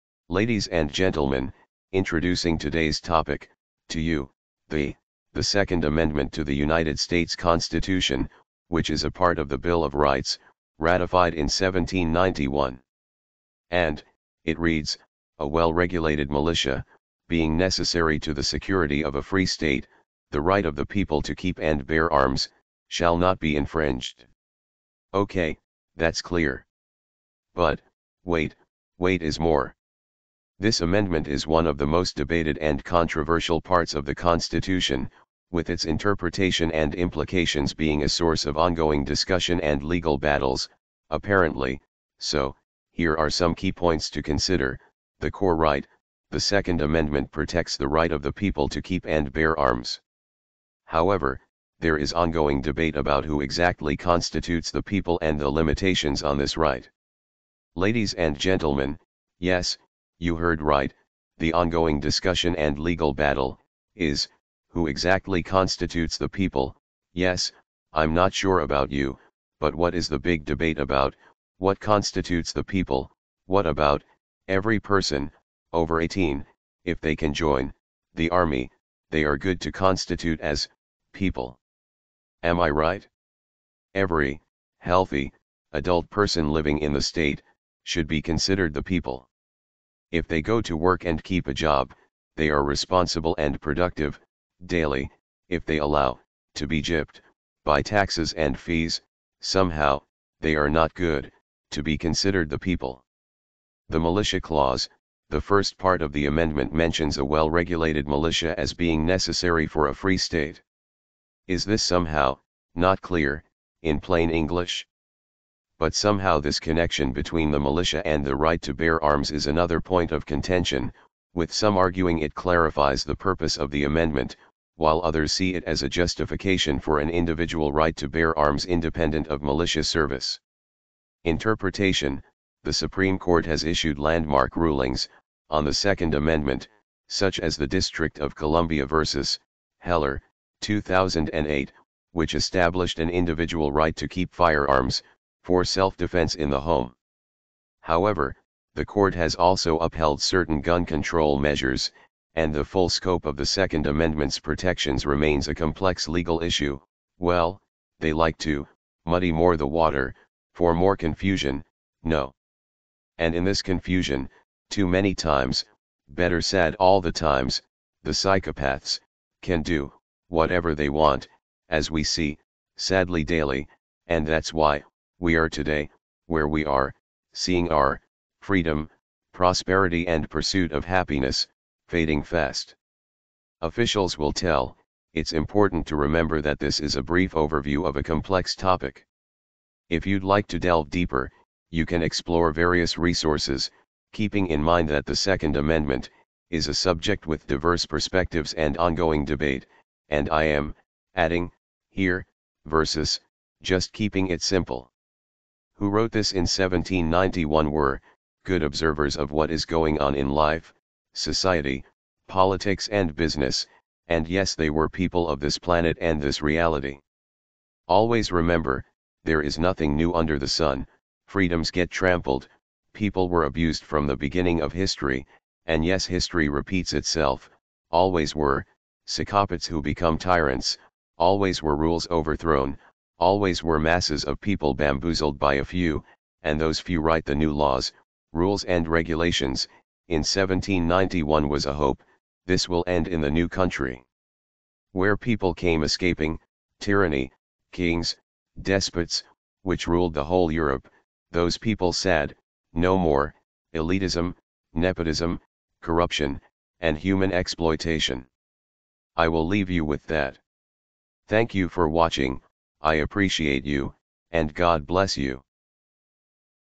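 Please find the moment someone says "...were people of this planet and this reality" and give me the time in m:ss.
3:34.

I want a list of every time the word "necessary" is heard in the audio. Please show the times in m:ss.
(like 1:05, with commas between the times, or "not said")
0:17, 1:49.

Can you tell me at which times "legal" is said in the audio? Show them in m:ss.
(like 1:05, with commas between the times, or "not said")
0:39, 1:02, 2:36.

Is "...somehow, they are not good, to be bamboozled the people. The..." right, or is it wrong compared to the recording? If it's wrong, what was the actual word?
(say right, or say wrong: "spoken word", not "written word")
wrong: "considered", not "bamboozled".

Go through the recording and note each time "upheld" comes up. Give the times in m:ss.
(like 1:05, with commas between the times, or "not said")
2:29.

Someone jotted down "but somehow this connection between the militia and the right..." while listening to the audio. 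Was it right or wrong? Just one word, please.
right.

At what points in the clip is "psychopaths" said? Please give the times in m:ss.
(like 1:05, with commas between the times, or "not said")
2:48, 3:49.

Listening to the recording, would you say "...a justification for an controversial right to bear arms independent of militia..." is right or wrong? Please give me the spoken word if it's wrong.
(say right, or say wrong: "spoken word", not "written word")
wrong: "individual", not "controversial".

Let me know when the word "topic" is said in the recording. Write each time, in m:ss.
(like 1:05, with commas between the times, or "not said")
0:03, 3:08.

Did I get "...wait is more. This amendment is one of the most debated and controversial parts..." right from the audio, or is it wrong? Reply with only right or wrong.
right.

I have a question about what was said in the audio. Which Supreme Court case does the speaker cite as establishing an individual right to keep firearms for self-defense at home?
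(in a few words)
District of Columbia vs. Heller.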